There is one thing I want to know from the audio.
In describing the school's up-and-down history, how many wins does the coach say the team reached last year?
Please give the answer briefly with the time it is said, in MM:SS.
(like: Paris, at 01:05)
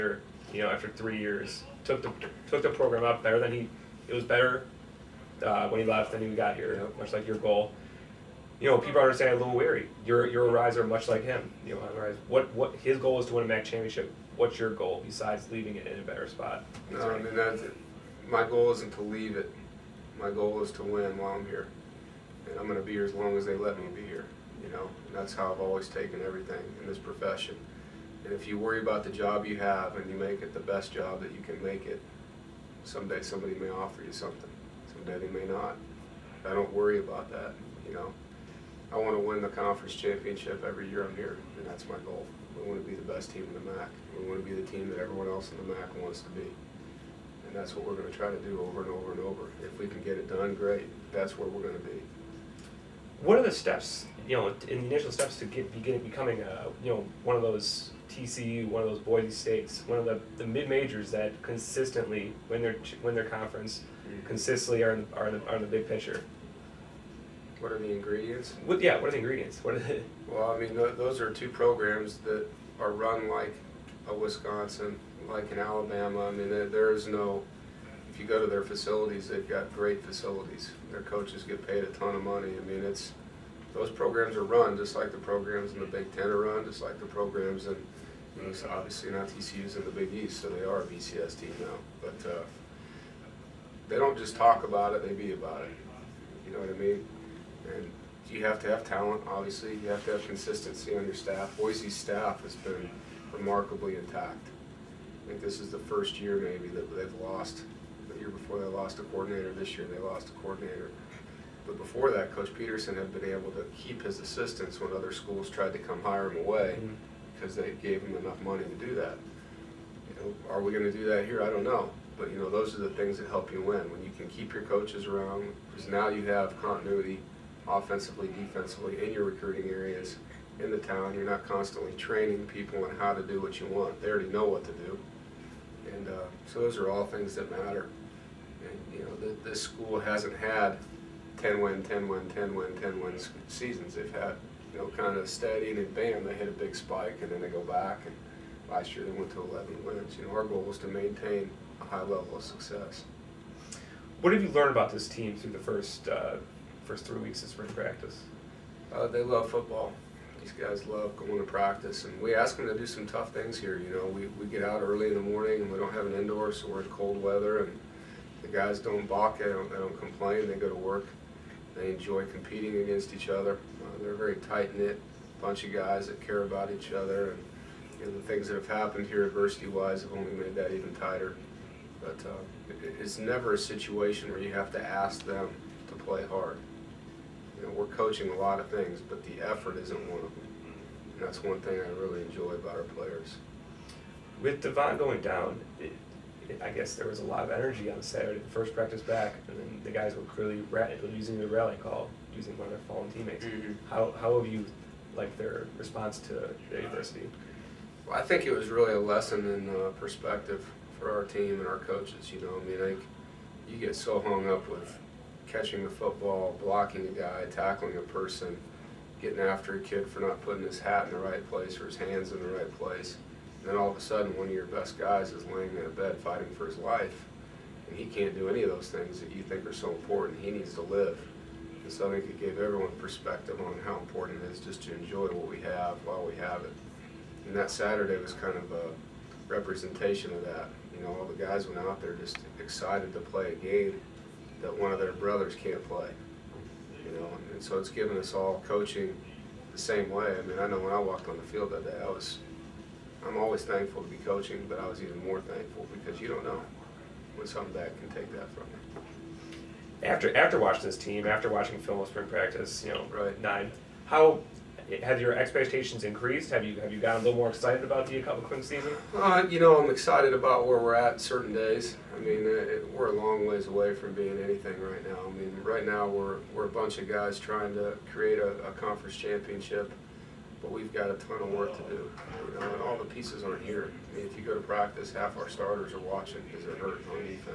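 11, at 02:29.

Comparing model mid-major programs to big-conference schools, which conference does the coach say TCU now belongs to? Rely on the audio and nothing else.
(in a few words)
Big East.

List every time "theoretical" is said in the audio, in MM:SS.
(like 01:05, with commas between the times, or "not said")
not said.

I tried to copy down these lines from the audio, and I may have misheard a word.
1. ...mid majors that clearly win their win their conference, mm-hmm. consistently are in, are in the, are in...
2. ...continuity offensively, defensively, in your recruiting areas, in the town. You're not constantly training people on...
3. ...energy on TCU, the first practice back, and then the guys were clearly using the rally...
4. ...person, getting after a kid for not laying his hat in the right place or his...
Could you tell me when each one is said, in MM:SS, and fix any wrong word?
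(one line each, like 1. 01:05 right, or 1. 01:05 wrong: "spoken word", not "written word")
1. 01:00 wrong: "consistently", not "clearly"
2. 02:06 right
3. 03:17 wrong: "Saturday", not "TCU"
4. 03:38 wrong: "putting", not "laying".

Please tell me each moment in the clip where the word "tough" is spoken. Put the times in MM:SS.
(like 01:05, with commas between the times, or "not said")
02:43.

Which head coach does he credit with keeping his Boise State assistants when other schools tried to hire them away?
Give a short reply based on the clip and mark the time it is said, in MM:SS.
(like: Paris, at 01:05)
Coach Petersen, at 01:52.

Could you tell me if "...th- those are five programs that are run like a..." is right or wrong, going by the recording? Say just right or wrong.
wrong.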